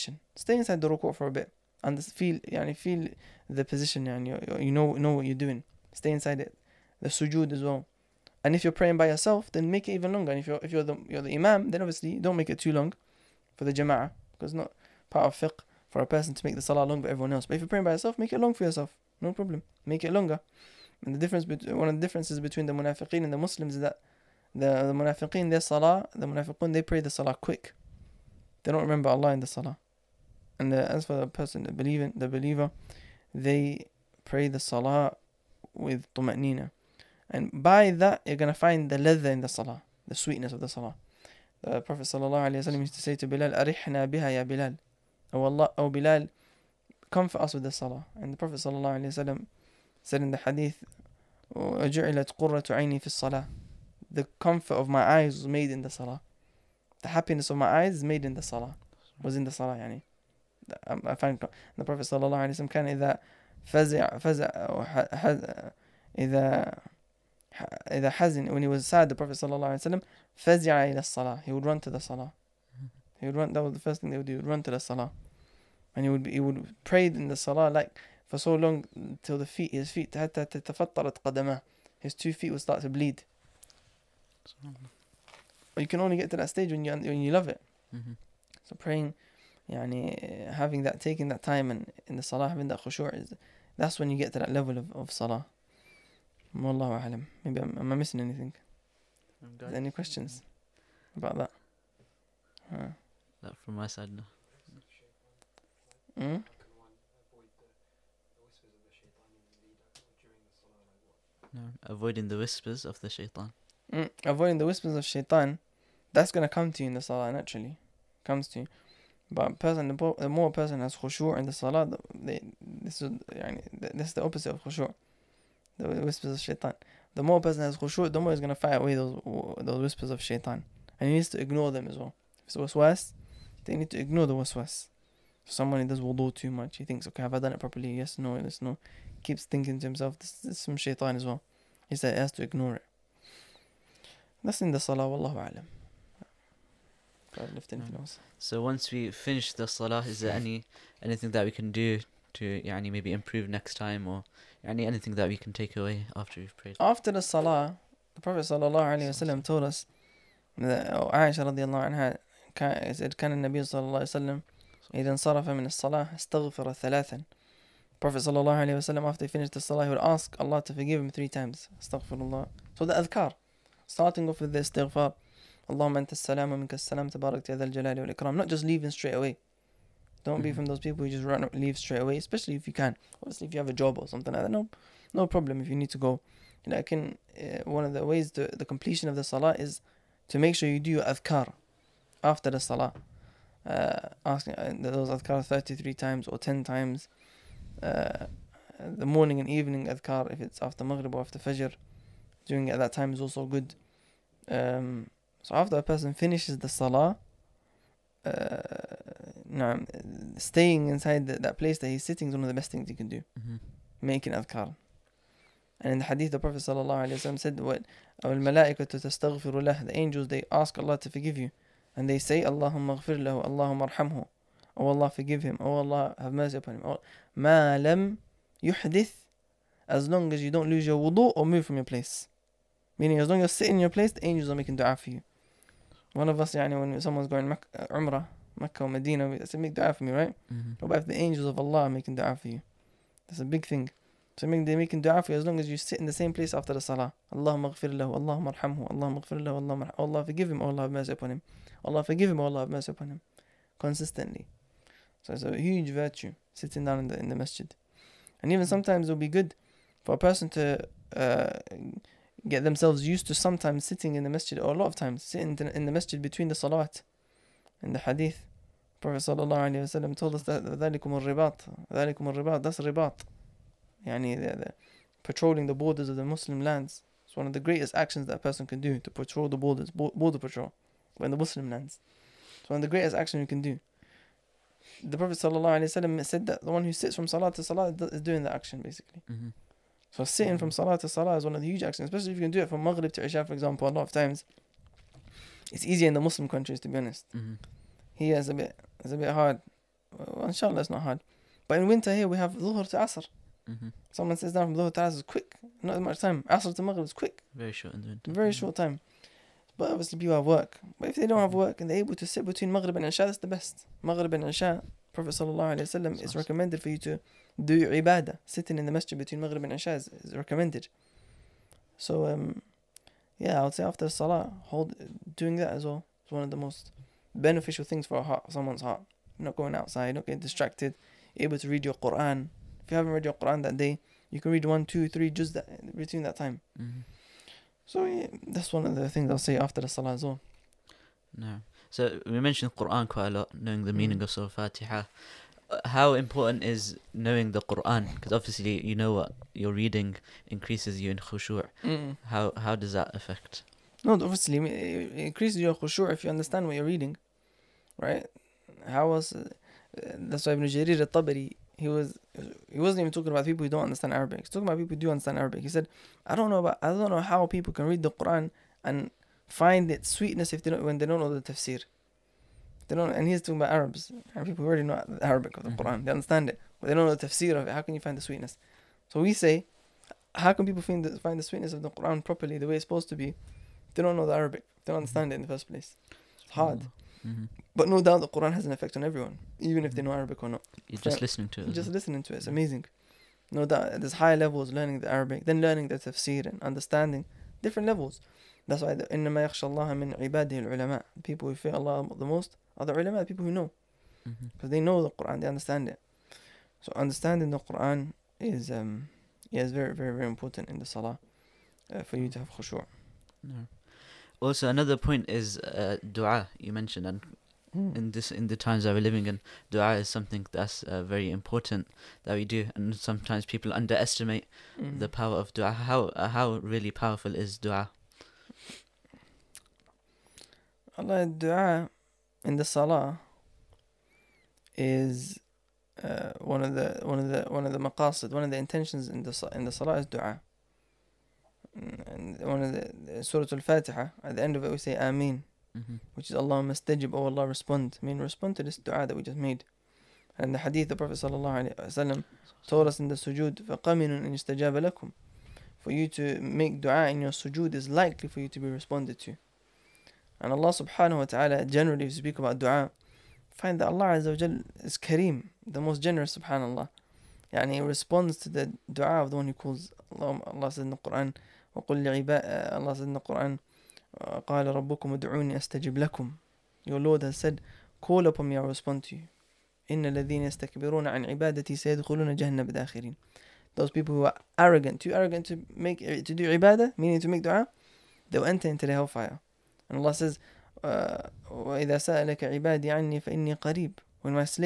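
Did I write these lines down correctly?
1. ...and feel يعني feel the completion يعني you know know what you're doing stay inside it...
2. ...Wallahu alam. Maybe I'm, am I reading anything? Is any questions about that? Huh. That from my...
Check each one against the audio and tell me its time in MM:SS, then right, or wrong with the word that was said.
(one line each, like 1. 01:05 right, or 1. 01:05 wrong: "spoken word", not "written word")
1. 00:01 wrong: "position", not "completion"
2. 01:36 wrong: "missing", not "reading".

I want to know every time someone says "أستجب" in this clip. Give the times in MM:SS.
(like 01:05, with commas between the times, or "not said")
07:55.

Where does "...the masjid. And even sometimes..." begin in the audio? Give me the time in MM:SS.
04:17.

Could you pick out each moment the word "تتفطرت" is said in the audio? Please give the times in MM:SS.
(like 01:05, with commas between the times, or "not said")
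01:20.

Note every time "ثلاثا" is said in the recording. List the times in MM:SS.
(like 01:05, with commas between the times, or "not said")
02:46.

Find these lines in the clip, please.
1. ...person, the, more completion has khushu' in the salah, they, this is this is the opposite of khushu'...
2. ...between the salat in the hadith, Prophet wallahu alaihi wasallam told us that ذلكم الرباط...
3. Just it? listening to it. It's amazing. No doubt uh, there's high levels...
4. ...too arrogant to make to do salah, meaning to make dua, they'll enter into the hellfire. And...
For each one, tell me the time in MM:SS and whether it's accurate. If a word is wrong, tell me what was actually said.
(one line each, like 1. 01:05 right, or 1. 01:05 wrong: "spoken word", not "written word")
1. 01:59 wrong: "person", not "completion"
2. 04:26 wrong: "sallallahu", not "wallahu"
3. 06:31 right
4. 08:05 wrong: "ibadah", not "salah".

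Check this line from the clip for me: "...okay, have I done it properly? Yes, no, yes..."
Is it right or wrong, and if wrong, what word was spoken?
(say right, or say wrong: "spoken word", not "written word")
right.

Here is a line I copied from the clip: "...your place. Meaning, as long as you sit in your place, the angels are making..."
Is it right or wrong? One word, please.
right.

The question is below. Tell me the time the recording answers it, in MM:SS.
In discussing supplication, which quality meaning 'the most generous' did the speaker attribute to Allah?
07:44.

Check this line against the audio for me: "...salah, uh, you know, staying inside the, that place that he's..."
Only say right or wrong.
right.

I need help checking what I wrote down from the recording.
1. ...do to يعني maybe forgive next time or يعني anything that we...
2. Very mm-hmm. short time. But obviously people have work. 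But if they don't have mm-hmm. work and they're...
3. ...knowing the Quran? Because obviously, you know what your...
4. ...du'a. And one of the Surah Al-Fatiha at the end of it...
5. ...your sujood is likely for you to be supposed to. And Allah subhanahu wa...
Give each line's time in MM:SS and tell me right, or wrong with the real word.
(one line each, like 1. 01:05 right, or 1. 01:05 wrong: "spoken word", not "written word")
1. 02:31 wrong: "improve", not "forgive"
2. 05:08 right
3. 05:47 right
4. 07:20 right
5. 07:37 wrong: "responded", not "supposed".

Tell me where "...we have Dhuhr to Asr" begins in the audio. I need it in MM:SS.
05:02.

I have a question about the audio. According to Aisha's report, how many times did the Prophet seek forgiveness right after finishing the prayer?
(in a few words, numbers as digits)
3.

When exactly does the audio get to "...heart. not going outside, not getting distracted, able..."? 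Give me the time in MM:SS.
05:28.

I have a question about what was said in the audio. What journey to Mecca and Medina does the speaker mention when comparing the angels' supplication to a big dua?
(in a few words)
Umrah.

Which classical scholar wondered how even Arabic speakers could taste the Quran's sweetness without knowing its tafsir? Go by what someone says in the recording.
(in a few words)
Ibn Jarir al-Tabari.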